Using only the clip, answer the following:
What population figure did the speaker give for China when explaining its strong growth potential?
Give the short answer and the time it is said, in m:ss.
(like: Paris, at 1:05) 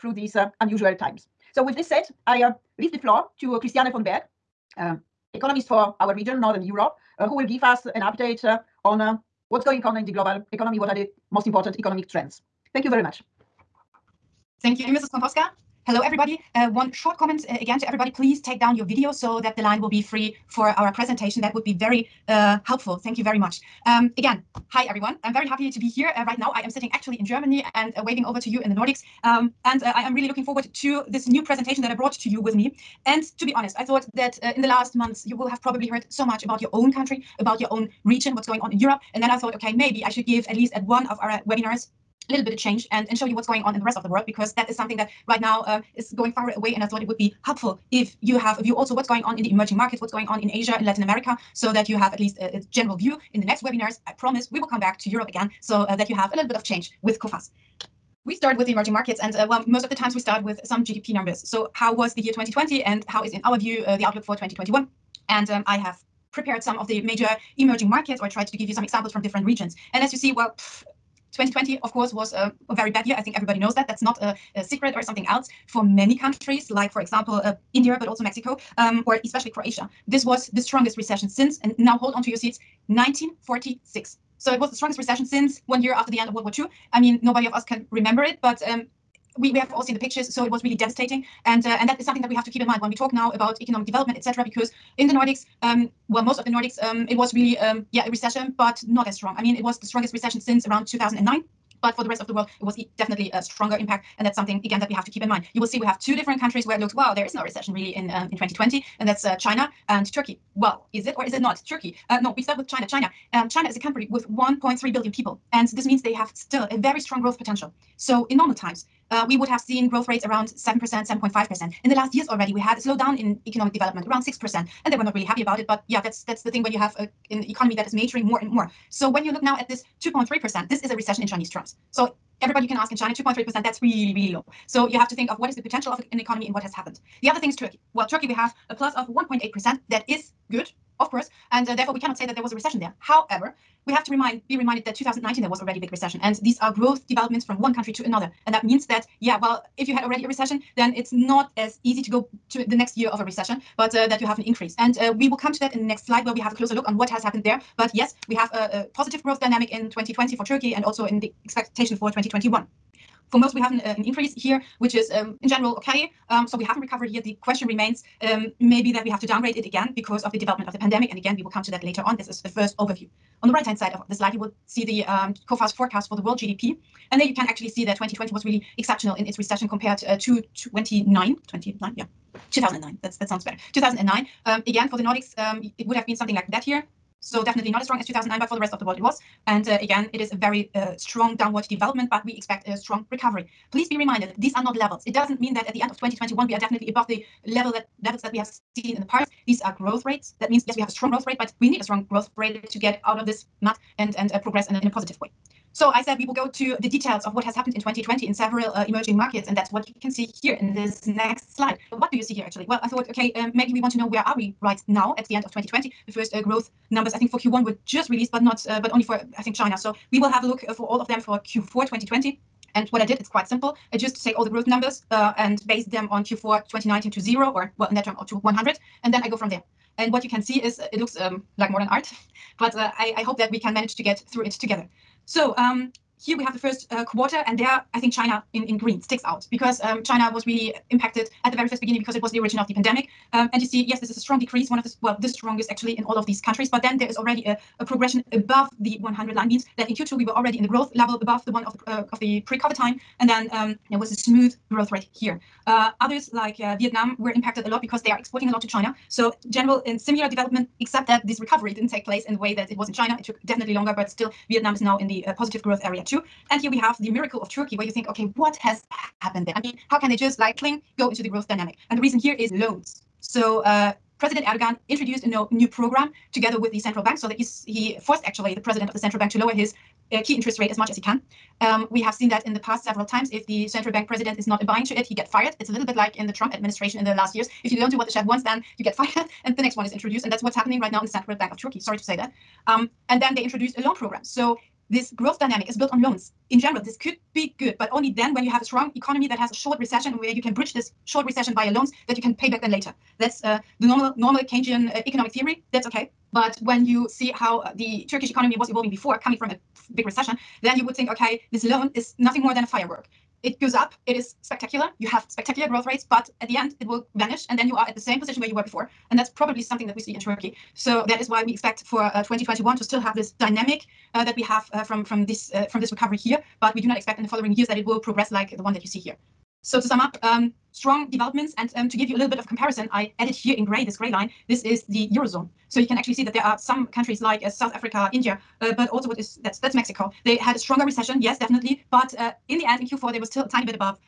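1.3 billion, at 1:54.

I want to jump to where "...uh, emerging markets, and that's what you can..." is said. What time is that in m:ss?
3:28.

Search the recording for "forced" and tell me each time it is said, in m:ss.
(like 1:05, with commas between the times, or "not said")
4:38.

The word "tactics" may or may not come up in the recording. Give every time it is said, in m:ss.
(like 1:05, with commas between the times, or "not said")
not said.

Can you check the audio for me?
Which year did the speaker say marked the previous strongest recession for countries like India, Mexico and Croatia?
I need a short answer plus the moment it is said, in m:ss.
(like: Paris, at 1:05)
1946, at 1:22.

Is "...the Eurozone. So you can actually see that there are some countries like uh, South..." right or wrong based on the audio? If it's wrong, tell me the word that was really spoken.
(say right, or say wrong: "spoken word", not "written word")
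right.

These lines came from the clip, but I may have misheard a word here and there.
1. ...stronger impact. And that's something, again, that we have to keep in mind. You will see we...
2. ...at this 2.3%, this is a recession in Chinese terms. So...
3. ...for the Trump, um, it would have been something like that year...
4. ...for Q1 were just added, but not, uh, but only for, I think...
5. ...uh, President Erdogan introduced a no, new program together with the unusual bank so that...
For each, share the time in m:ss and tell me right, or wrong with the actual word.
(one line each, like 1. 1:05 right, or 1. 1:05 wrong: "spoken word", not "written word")
1. 1:43 right
2. 2:09 right
3. 3:04 wrong: "Nordics", not "Trump"
4. 3:37 wrong: "released", not "added"
5. 4:33 wrong: "central", not "unusual".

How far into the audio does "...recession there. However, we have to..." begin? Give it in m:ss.
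2:22.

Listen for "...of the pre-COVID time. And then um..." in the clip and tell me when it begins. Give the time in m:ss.
4:12.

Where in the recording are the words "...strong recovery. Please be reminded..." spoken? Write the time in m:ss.
3:12.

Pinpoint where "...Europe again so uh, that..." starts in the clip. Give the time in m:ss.
0:55.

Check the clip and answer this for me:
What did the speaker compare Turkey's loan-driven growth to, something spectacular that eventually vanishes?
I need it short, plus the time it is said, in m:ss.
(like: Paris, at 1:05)
a firework, at 5:12.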